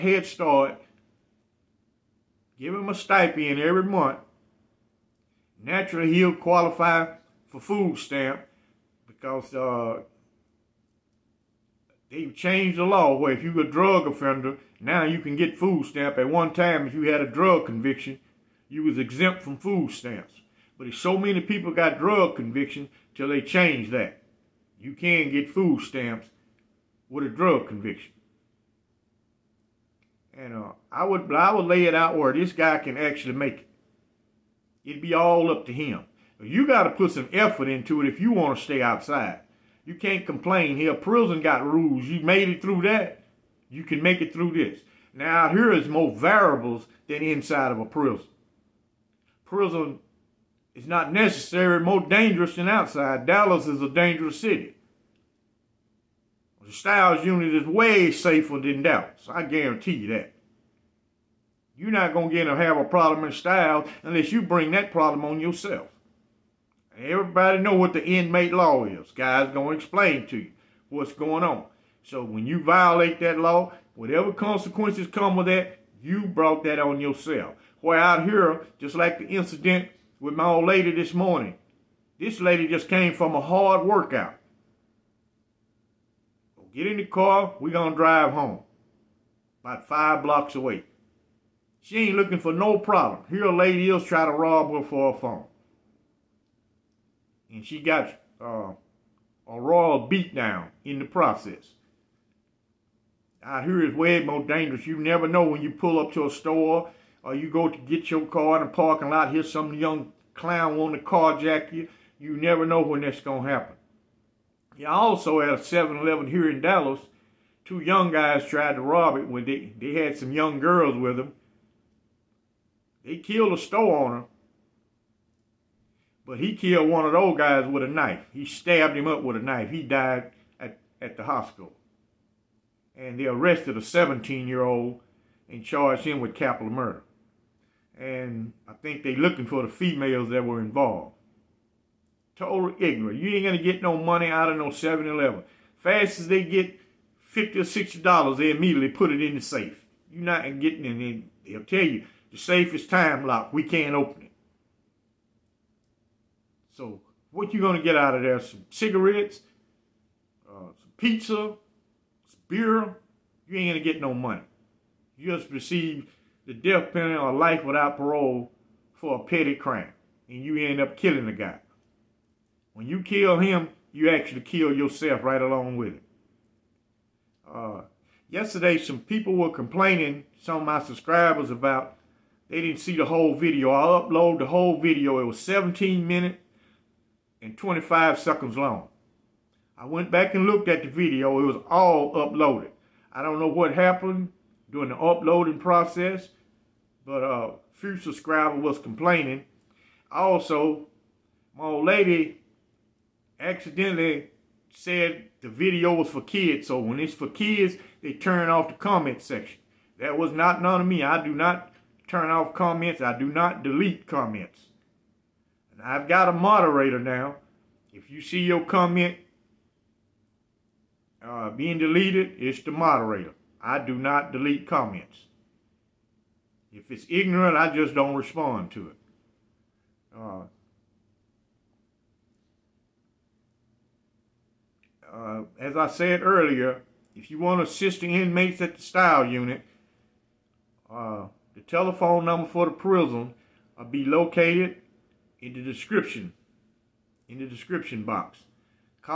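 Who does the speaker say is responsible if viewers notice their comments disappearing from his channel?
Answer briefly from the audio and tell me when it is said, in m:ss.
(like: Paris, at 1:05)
the moderator, at 3:42.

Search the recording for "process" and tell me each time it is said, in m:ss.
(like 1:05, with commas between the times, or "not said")
1:41, 3:15.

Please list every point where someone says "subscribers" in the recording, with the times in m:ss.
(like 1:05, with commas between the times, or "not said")
3:00, 3:17.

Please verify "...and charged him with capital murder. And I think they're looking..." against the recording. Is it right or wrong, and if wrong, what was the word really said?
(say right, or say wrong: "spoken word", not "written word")
right.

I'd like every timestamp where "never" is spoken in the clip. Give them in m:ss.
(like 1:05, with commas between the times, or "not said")
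1:44, 1:52.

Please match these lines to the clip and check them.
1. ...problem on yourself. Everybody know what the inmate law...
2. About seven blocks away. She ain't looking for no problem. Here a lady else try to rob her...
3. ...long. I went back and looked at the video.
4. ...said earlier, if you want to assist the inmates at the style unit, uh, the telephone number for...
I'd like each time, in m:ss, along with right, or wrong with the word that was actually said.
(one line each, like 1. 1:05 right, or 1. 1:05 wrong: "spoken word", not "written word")
1. 1:04 right
2. 1:29 wrong: "five", not "seven"
3. 3:08 right
4. 3:55 right.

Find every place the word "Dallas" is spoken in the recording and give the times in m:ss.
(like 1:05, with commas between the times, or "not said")
0:53, 0:58, 1:56.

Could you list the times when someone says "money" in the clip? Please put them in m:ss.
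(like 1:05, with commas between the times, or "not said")
2:23, 2:44.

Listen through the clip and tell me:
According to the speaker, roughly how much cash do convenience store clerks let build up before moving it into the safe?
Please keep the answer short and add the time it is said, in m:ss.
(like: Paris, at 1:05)
$50 or $60, at 2:27.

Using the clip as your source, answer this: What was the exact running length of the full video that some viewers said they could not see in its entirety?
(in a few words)
17 minutes 25 seconds.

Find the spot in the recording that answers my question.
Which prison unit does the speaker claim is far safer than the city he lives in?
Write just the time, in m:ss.
0:56.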